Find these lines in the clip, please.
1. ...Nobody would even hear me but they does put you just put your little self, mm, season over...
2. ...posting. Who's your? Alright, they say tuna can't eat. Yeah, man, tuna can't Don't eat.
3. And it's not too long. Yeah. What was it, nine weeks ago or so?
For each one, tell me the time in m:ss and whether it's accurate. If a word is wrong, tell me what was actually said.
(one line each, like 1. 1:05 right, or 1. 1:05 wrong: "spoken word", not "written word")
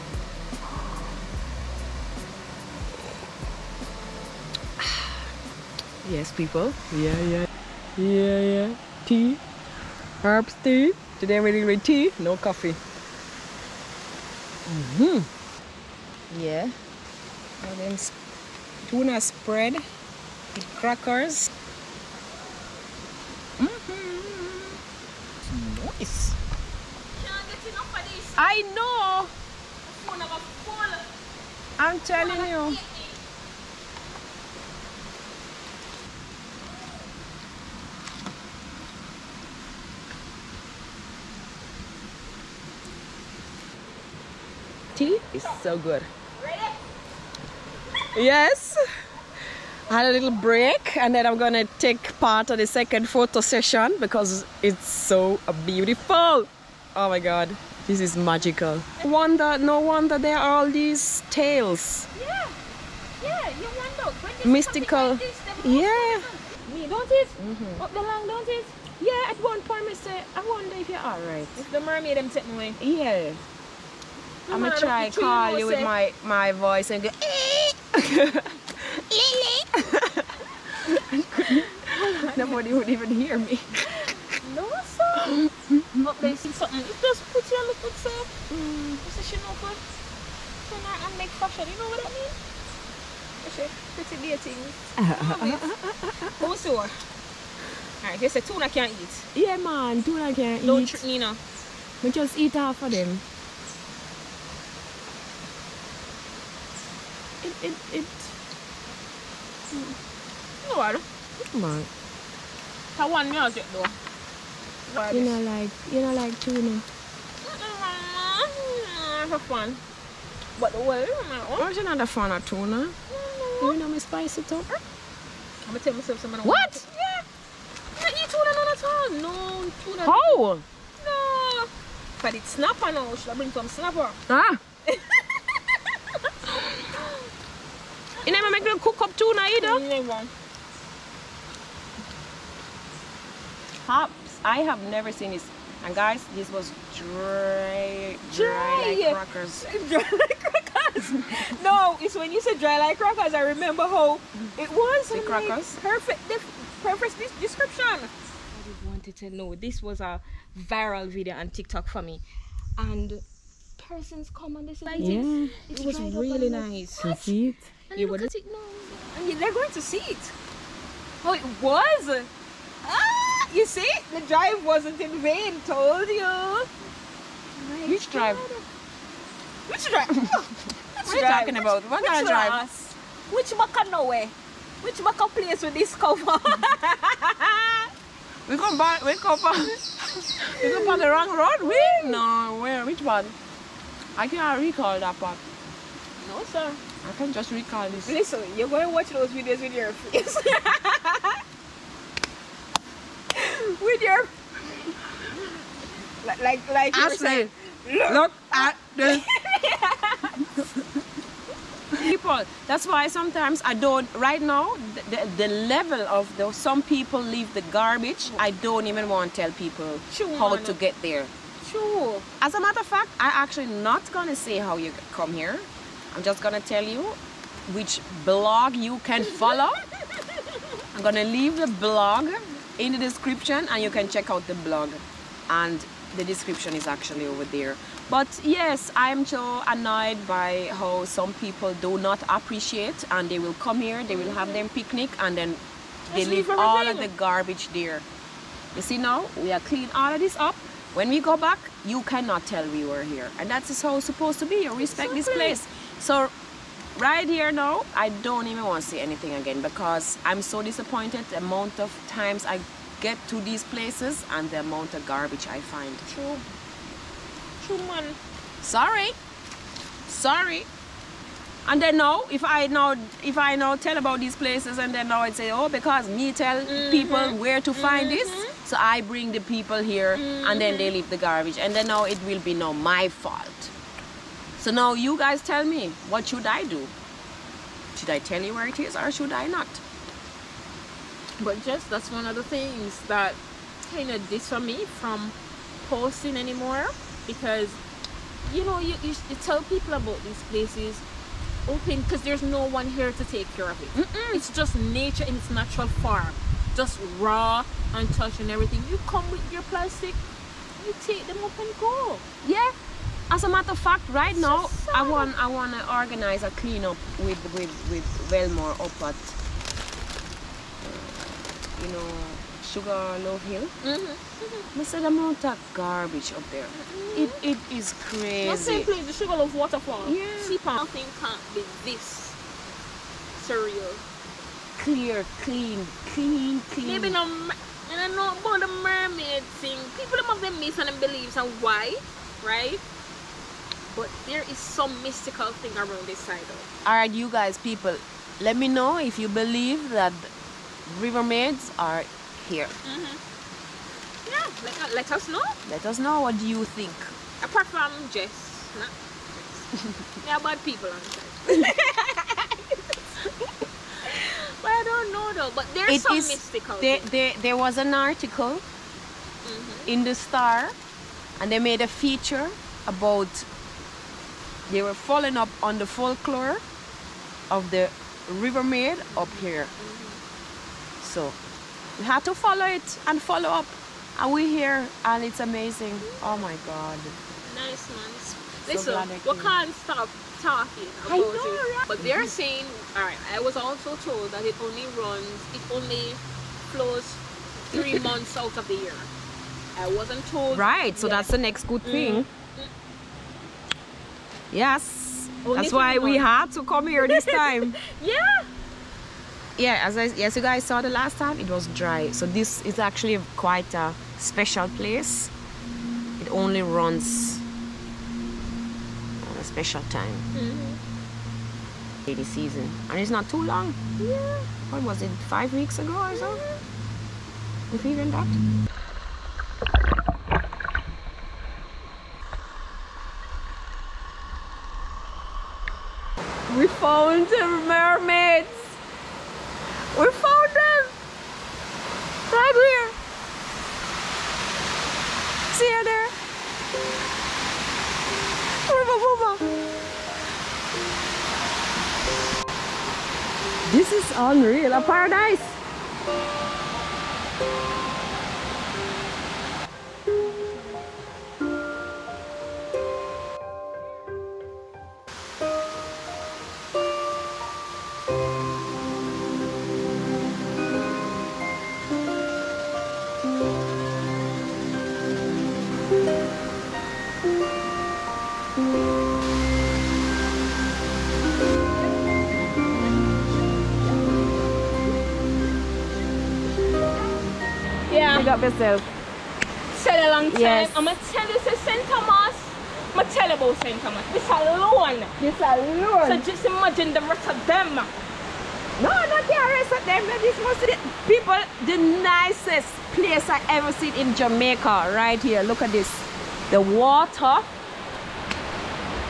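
1. 1:22 wrong: "position", not "season"
2. 1:34 wrong: "dating", not "posting"
3. 7:02 wrong: "five", not "nine".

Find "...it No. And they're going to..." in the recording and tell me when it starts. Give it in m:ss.
2:48.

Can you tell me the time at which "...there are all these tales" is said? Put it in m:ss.
1:00.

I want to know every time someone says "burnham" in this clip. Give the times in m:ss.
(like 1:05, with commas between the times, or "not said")
not said.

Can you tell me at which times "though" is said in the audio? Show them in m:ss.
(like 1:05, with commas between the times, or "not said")
1:53, 5:46, 6:05.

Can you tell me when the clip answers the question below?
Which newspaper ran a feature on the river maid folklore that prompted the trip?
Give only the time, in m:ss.
6:10.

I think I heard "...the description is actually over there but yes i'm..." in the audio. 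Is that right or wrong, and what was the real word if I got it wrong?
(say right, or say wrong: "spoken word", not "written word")
right.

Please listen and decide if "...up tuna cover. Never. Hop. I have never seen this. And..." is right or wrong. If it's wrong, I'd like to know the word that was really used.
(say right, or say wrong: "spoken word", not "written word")
wrong: "either", not "cover".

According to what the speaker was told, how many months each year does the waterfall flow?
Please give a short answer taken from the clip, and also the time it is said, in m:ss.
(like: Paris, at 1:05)
3 months, at 6:37.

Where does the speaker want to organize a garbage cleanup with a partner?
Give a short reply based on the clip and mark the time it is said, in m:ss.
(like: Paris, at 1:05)
Sugarloaf Hill, at 5:22.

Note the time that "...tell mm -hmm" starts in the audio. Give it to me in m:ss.
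4:36.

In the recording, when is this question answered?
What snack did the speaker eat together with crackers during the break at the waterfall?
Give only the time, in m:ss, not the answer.
0:18.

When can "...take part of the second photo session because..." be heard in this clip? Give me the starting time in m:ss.
0:51.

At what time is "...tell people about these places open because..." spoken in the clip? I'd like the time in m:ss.
4:59.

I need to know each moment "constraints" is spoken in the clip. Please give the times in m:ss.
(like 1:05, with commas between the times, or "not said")
not said.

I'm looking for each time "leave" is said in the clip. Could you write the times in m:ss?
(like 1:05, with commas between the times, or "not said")
3:37, 3:51, 4:06, 4:40.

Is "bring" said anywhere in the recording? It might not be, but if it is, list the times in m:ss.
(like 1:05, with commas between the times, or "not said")
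2:13, 4:39.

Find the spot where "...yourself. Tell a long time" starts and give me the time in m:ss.
8:08.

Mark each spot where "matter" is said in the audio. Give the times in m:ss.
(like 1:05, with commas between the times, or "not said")
3:42, 5:13.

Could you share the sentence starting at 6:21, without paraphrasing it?
So we had to follow it and follow up.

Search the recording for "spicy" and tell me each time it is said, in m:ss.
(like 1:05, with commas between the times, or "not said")
2:03.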